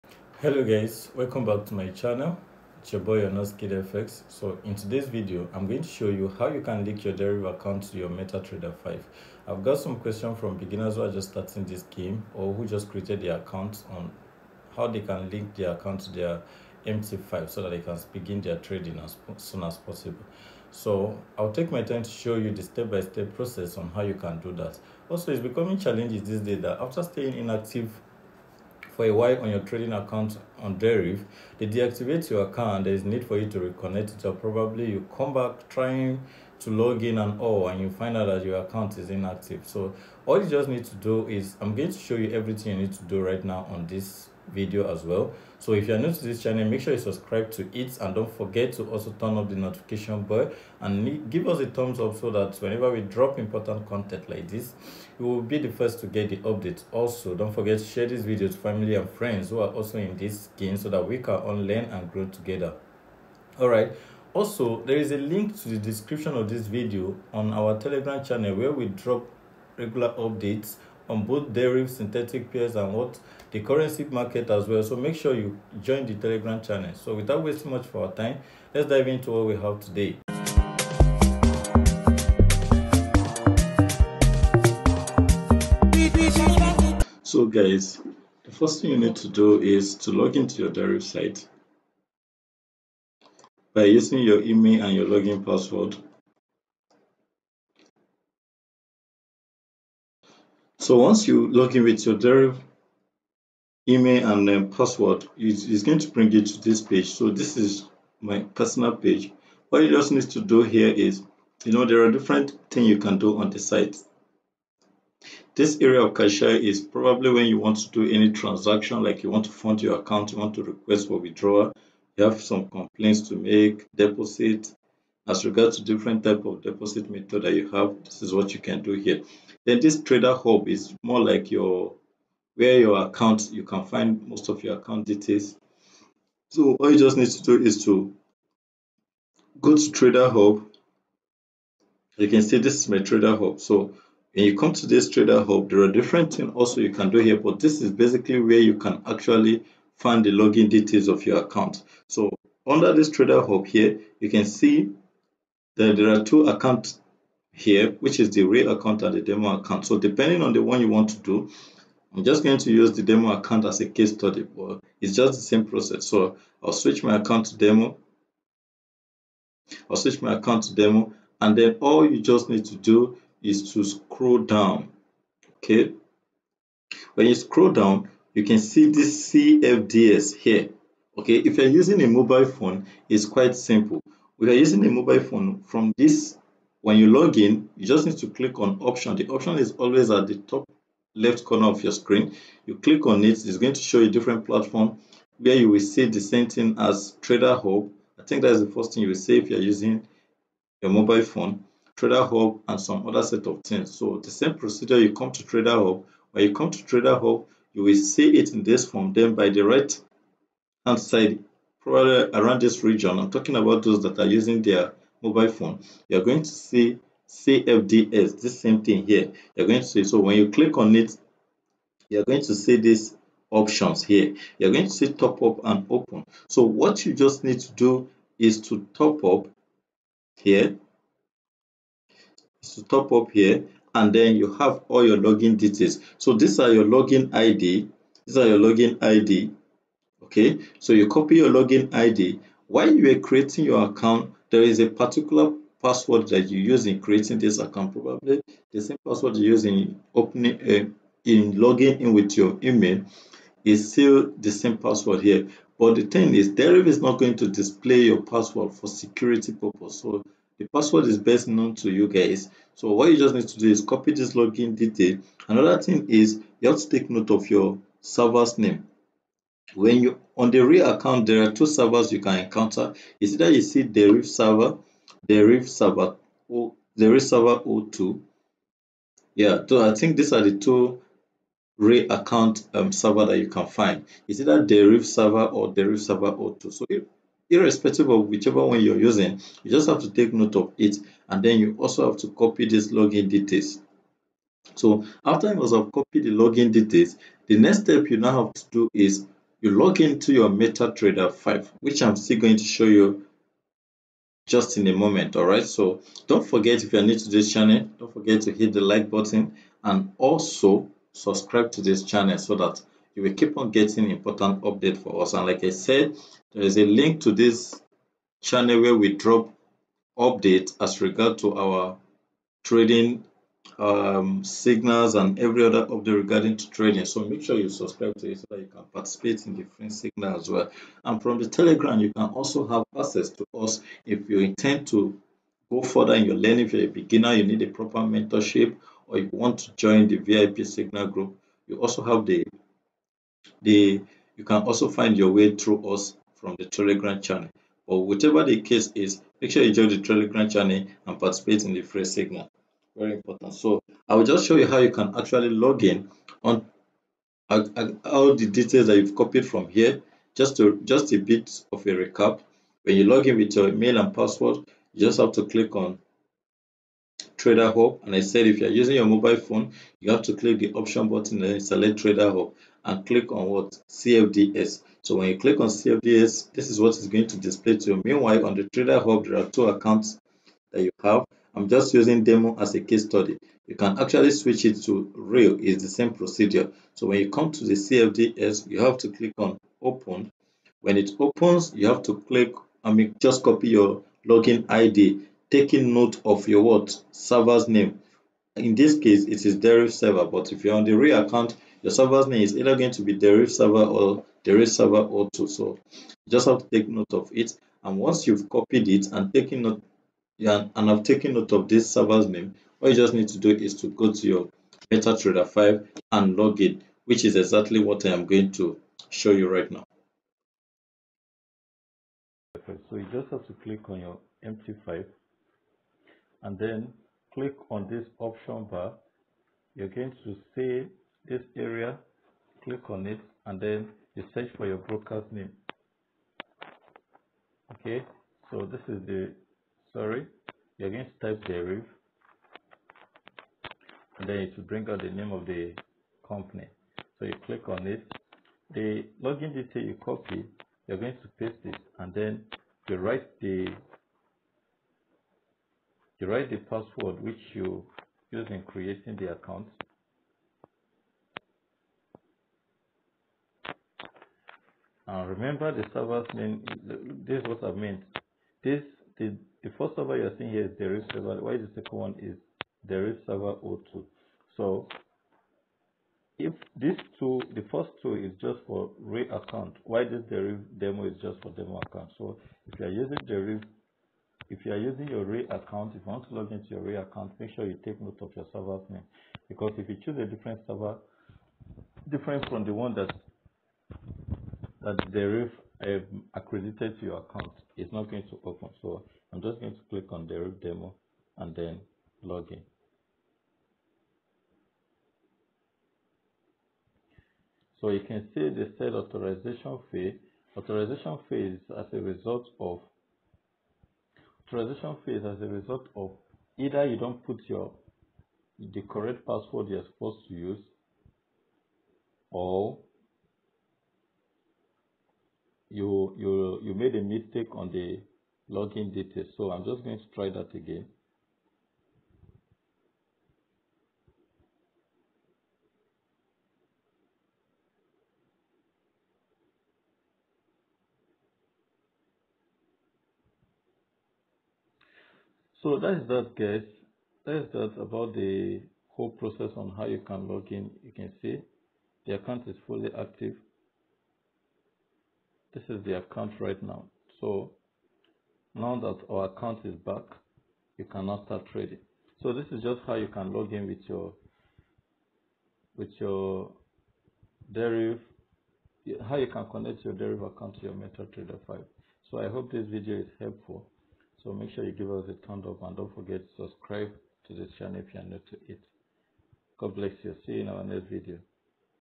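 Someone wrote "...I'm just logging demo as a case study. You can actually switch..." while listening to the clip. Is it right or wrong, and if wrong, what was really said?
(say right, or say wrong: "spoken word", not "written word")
wrong: "using", not "logging".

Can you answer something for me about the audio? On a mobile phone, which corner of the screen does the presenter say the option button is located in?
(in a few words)
Top left.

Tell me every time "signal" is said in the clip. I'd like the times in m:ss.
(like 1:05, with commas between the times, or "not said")
5:24, 5:29, 5:40, 5:52.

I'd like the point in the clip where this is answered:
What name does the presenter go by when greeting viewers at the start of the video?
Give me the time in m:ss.
0:03.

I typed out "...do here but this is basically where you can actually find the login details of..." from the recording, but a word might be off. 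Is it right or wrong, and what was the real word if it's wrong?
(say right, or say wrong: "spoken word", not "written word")
right.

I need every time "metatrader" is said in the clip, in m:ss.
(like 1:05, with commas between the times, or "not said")
0:08, 5:00, 6:54, 9:30.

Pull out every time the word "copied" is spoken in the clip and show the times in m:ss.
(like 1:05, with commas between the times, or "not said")
4:55, 5:59, 6:48.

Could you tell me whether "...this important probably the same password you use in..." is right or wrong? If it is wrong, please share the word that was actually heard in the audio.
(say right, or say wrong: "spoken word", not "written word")
wrong: "account", not "important".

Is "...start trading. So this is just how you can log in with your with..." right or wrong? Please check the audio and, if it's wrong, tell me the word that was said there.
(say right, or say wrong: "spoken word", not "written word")
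right.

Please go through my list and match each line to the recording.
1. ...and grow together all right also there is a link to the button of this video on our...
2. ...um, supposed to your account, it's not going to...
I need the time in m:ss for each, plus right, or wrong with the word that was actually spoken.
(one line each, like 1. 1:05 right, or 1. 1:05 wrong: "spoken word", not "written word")
1. 1:01 wrong: "description", not "button"
2. 8:15 wrong: "accredited", not "supposed".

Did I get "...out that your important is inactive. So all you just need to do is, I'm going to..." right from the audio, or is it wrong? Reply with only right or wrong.
wrong.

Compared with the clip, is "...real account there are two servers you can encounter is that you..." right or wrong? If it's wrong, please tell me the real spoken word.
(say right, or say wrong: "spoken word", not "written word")
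right.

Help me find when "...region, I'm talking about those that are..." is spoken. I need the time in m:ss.
3:32.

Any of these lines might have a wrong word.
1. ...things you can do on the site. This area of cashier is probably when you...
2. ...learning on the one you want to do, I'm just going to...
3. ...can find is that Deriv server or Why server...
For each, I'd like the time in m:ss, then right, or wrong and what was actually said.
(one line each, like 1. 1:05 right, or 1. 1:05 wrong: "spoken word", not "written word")
1. 1:52 right
2. 2:39 wrong: "depending", not "learning"
3. 4:43 wrong: "Deriv", not "Why".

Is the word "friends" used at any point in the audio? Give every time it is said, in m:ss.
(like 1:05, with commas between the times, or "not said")
0:59.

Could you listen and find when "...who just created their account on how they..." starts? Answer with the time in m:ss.
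0:12.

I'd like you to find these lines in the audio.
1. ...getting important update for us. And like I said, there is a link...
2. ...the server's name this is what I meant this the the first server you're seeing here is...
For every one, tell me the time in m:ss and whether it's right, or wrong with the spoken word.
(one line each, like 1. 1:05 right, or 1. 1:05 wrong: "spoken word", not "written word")
1. 5:13 right
2. 7:45 right.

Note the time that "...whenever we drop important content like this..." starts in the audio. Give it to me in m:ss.
0:52.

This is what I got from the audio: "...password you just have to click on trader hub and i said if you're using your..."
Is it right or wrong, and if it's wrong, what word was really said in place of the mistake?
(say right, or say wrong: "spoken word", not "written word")
right.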